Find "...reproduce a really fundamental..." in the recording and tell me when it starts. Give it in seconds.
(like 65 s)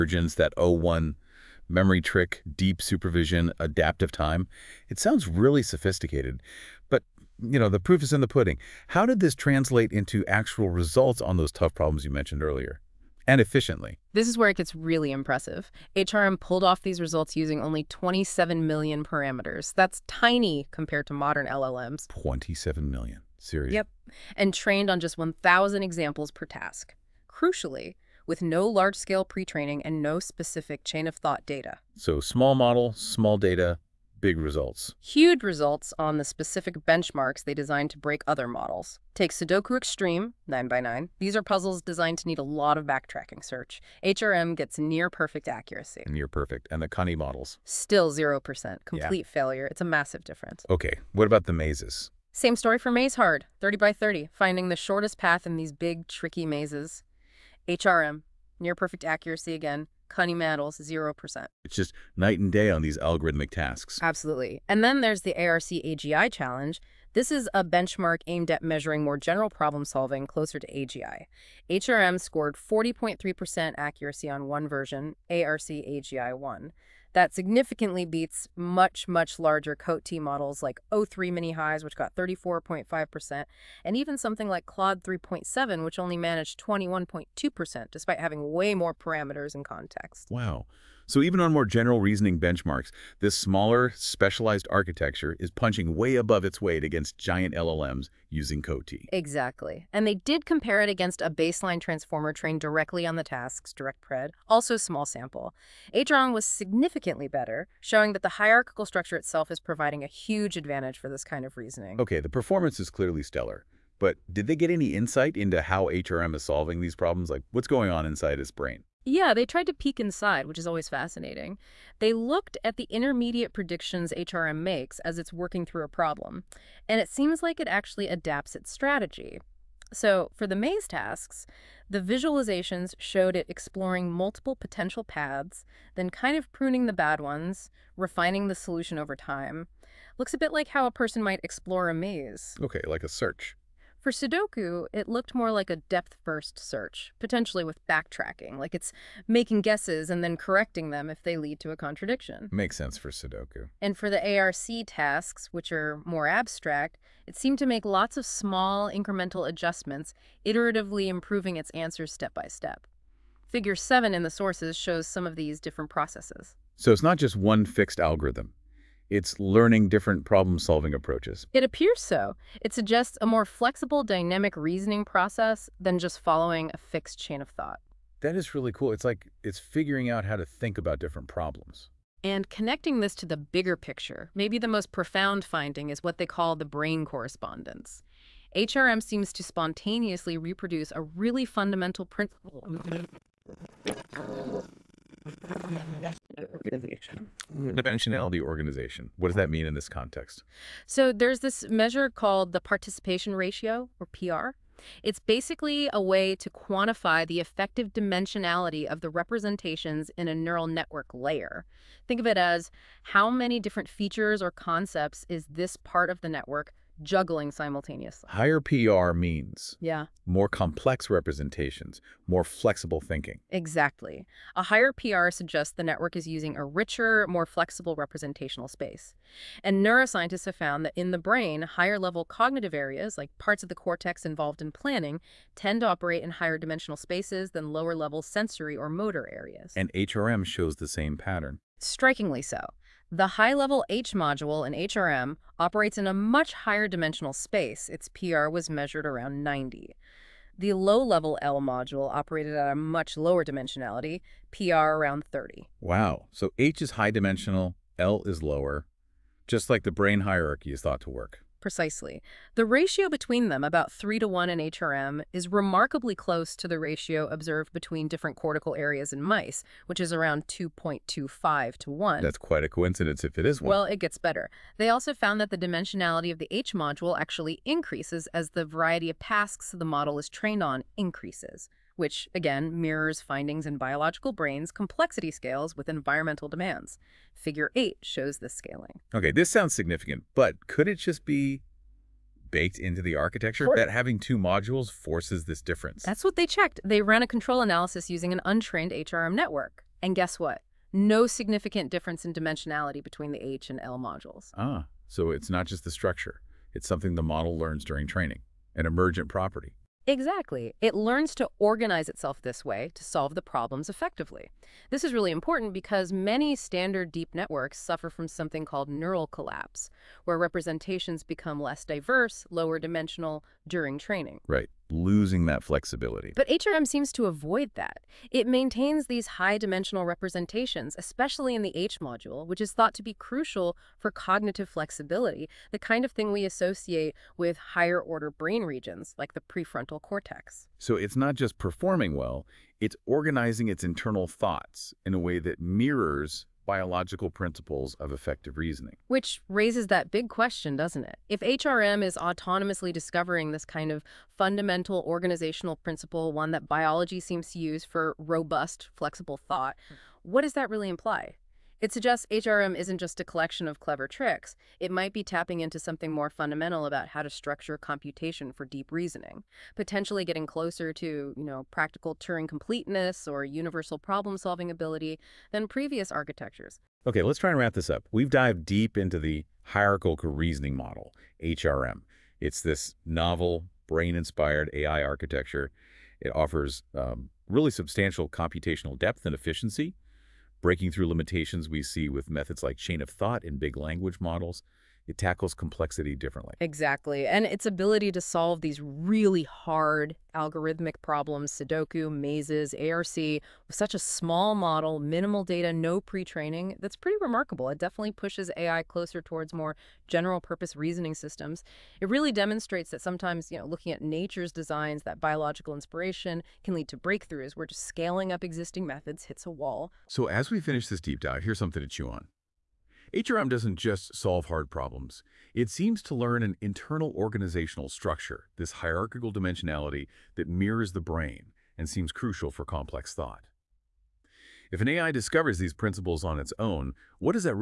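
190 s.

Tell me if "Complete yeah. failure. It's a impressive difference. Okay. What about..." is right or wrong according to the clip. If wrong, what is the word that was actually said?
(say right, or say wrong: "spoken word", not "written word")
wrong: "massive", not "impressive".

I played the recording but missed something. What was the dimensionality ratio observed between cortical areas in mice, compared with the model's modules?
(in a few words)
2.25 to 1.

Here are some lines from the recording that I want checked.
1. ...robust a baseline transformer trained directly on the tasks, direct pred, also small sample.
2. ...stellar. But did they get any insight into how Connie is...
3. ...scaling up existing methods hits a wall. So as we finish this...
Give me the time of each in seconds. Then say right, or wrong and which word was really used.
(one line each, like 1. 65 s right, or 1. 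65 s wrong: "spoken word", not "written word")
1. 100 s wrong: "against", not "robust"
2. 113 s wrong: "HRM", not "Connie"
3. 417 s right.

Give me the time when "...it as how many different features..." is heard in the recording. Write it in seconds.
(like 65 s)
212 s.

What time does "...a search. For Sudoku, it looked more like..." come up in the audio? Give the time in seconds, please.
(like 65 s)
143 s.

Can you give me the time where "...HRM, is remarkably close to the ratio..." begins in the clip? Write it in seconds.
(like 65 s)
264 s.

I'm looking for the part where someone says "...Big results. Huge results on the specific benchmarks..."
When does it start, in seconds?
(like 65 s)
34 s.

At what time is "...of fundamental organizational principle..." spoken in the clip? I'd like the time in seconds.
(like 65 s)
353 s.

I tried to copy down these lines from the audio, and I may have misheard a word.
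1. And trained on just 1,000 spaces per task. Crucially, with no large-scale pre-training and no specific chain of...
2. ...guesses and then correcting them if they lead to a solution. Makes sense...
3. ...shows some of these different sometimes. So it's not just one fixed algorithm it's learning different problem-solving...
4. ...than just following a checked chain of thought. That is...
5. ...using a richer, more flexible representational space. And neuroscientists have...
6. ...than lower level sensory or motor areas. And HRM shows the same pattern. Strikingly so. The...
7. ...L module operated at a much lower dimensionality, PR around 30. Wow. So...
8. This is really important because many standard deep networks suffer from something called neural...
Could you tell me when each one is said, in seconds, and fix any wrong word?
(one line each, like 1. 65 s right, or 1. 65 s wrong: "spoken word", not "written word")
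1. 24 s wrong: "examples", not "spaces"
2. 149 s wrong: "contradiction", not "solution"
3. 164 s wrong: "processes", not "sometimes"
4. 175 s wrong: "fixed", not "checked"
5. 226 s right
6. 237 s right
7. 251 s right
8. 314 s right.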